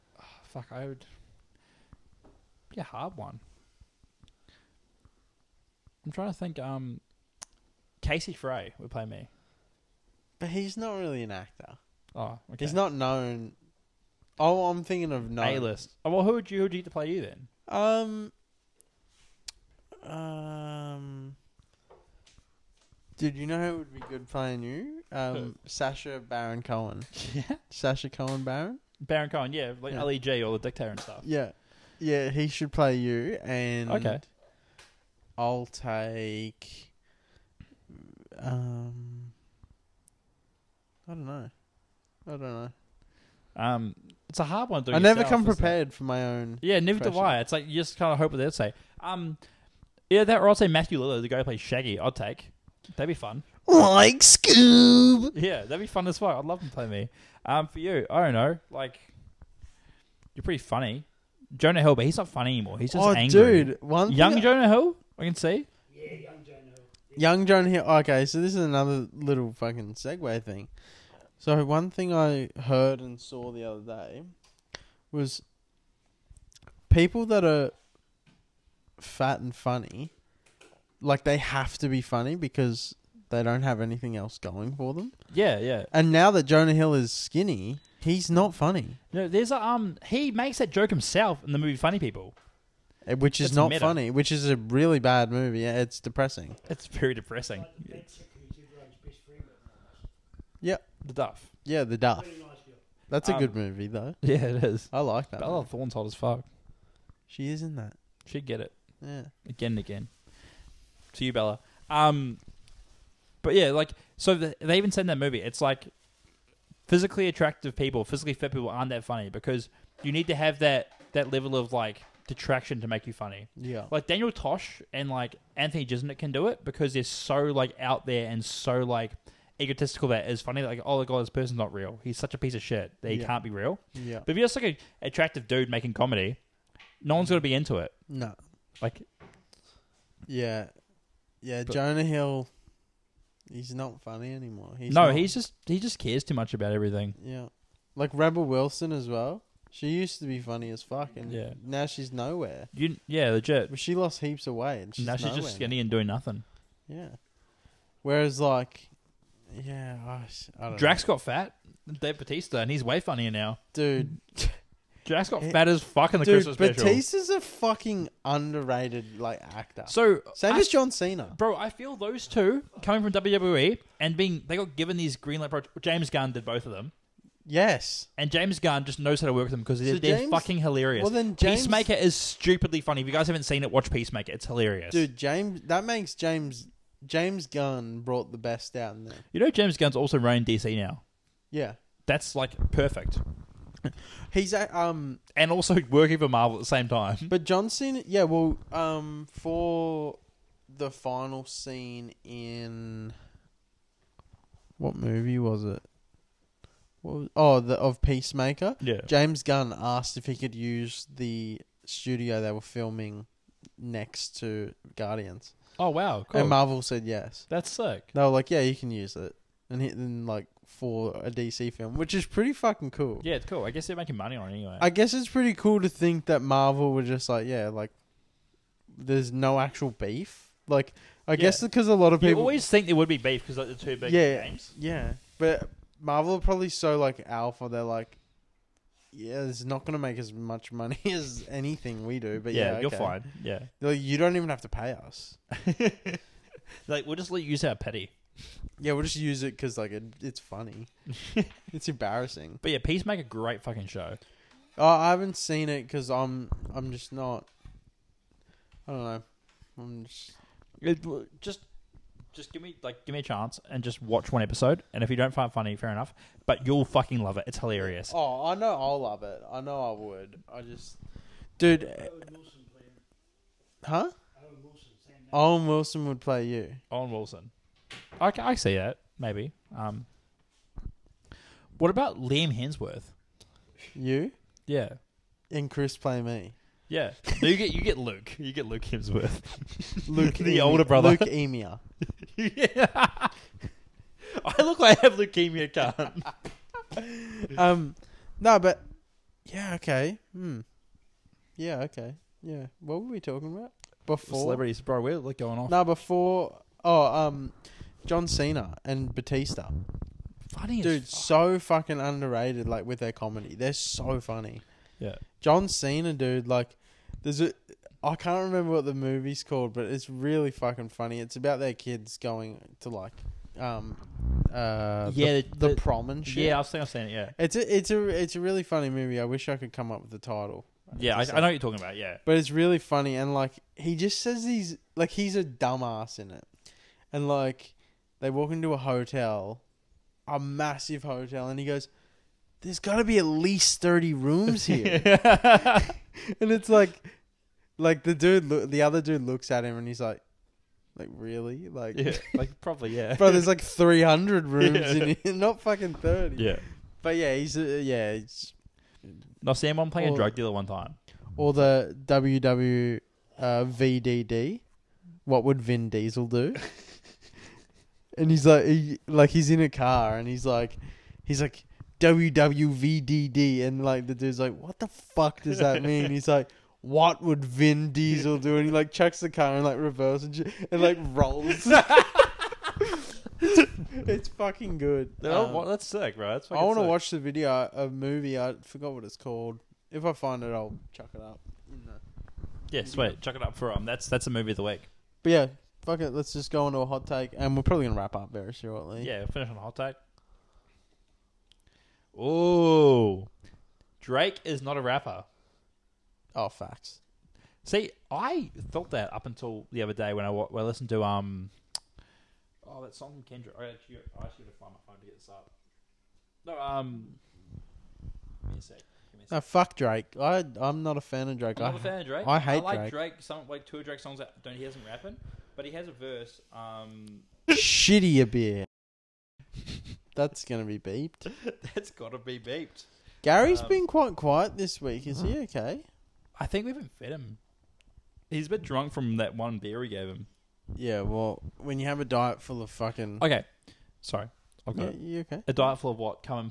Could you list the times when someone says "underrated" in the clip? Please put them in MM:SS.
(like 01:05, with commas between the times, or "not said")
02:48, 05:11.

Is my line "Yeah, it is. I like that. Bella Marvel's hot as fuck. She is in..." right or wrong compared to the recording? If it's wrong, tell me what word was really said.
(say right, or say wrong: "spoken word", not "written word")
wrong: "Thorne", not "Marvel".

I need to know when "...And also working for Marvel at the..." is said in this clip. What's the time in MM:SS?
03:15.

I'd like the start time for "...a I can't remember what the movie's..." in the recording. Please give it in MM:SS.
05:17.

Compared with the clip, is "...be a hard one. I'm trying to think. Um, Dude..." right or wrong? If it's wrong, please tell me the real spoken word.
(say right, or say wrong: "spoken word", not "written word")
wrong: "Casey", not "Dude".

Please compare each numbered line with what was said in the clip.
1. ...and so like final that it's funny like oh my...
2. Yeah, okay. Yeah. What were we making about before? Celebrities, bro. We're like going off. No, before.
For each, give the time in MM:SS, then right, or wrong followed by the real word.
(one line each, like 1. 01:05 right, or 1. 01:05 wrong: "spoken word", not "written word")
1. 02:08 wrong: "egotistical", not "final"
2. 05:01 wrong: "talking", not "making".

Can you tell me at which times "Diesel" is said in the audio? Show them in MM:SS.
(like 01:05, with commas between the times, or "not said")
06:05, 06:17.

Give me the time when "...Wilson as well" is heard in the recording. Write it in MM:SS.
02:28.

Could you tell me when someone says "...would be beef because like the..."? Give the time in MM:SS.
03:52.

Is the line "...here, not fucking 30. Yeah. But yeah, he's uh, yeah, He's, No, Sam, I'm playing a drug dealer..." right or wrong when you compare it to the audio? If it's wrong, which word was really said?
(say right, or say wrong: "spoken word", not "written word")
right.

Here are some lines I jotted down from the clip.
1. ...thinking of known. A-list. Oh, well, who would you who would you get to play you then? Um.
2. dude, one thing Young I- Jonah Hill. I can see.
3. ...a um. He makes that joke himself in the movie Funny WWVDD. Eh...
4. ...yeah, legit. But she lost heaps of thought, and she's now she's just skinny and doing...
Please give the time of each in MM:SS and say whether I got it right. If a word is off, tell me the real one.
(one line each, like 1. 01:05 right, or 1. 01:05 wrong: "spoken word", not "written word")
1. 00:14 right
2. 01:03 right
3. 01:29 wrong: "People", not "WWVDD"
4. 02:33 wrong: "weight", not "thought".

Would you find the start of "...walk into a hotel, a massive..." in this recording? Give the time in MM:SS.
05:38.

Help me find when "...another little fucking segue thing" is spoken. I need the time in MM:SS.
01:08.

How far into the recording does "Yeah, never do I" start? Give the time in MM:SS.
00:46.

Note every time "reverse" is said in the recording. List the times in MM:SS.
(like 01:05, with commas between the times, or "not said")
06:19.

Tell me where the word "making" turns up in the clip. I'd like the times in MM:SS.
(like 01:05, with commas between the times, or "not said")
02:15, 03:43.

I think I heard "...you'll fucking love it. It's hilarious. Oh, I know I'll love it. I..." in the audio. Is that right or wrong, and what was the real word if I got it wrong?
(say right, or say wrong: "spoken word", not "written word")
right.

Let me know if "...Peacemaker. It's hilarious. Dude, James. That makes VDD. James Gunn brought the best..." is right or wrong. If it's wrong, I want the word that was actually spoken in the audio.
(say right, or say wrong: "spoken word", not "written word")
wrong: "James", not "VDD".